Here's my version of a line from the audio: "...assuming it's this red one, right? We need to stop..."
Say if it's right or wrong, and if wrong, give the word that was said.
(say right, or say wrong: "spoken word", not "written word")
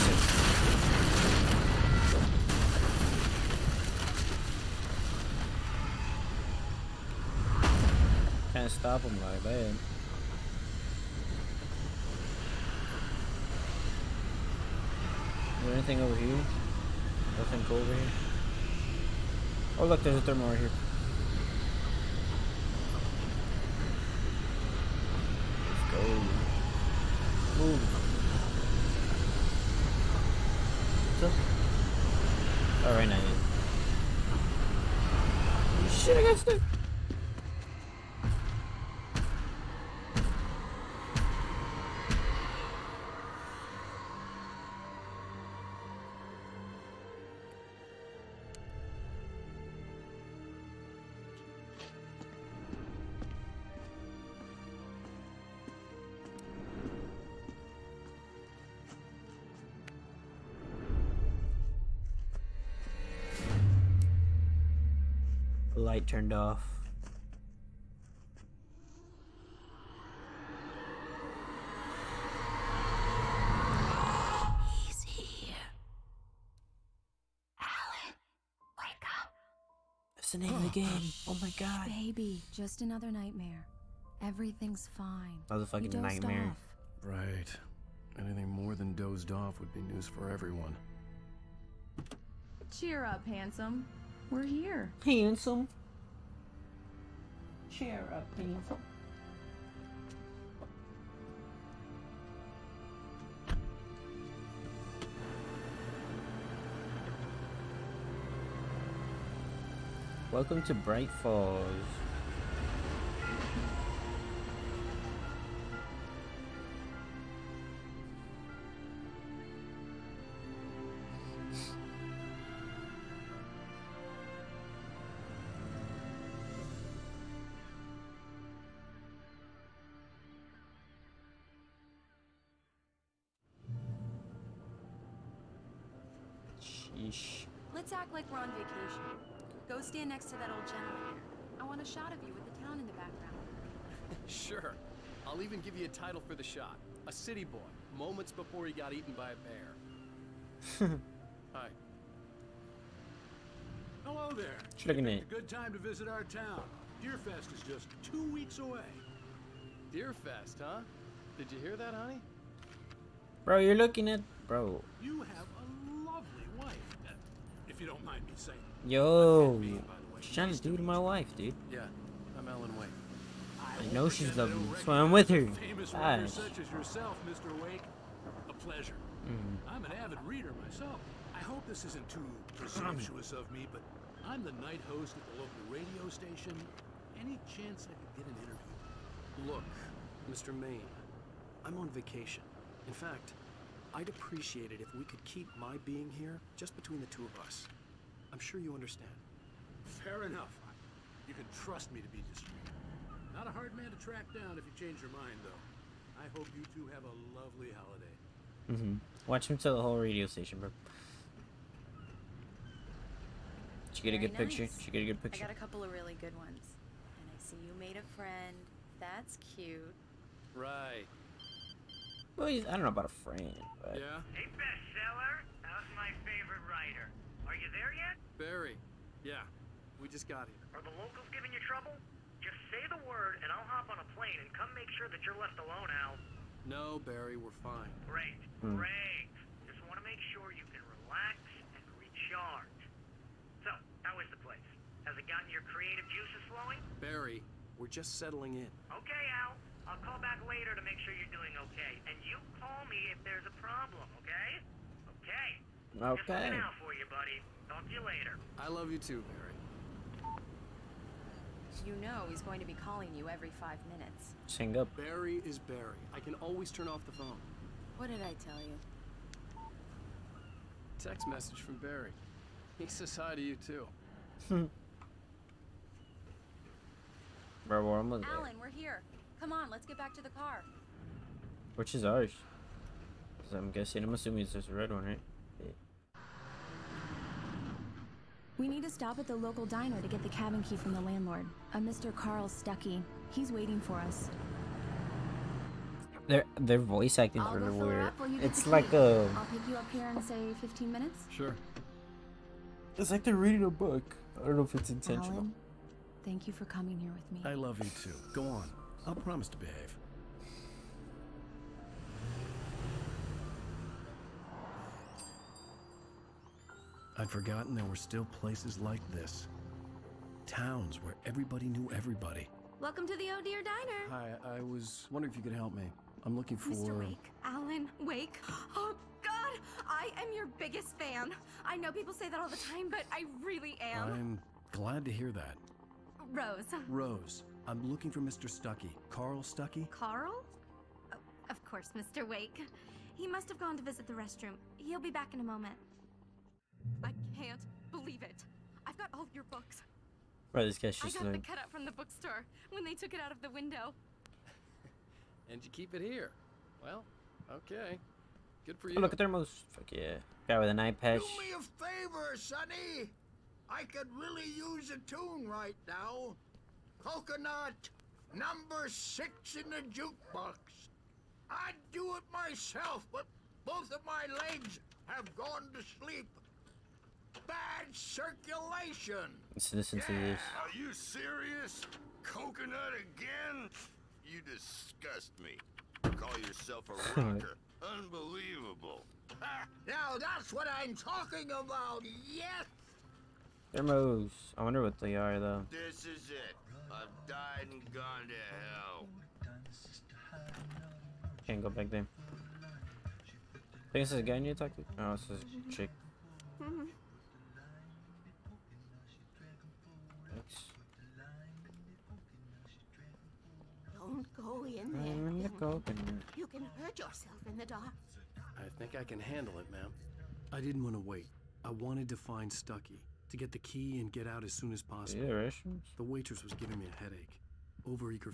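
right.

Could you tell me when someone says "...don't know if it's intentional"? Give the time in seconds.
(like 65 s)
304 s.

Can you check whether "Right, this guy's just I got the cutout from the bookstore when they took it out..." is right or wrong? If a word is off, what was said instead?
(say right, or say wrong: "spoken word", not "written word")
right.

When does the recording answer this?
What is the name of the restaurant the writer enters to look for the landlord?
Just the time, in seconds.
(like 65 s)
323 s.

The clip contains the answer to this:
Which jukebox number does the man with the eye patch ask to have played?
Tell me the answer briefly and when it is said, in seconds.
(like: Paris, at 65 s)
6, at 368 s.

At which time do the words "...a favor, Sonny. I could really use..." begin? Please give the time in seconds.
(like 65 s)
361 s.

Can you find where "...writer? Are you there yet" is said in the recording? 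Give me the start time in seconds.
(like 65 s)
226 s.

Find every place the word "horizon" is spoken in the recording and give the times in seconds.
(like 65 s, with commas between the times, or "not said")
not said.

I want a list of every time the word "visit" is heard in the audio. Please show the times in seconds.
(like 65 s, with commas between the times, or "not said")
155 s, 343 s.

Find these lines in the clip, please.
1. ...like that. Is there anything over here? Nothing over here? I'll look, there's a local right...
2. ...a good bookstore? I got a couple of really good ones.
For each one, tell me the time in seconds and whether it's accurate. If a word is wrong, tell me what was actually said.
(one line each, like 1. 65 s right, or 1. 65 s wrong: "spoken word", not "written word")
1. 9 s wrong: "thermal", not "local"
2. 215 s wrong: "picture", not "bookstore".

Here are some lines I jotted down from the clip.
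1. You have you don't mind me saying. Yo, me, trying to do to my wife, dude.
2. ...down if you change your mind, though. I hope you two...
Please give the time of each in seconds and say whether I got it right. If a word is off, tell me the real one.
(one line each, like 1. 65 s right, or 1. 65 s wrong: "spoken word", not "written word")
1. 165 s right
2. 204 s right.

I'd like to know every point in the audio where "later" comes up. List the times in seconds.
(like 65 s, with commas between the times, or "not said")
250 s, 257 s.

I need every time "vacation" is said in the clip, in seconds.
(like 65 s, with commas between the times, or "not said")
138 s, 191 s.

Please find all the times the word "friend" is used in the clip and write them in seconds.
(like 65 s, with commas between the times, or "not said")
218 s, 223 s.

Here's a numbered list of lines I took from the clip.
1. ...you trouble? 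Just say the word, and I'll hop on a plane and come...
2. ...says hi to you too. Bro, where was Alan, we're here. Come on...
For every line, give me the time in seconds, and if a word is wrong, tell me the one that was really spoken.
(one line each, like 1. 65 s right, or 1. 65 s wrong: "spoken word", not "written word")
1. 231 s right
2. 272 s right.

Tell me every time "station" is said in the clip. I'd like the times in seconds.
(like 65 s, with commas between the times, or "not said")
186 s, 210 s.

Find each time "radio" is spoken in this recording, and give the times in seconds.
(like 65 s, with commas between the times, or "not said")
185 s, 209 s.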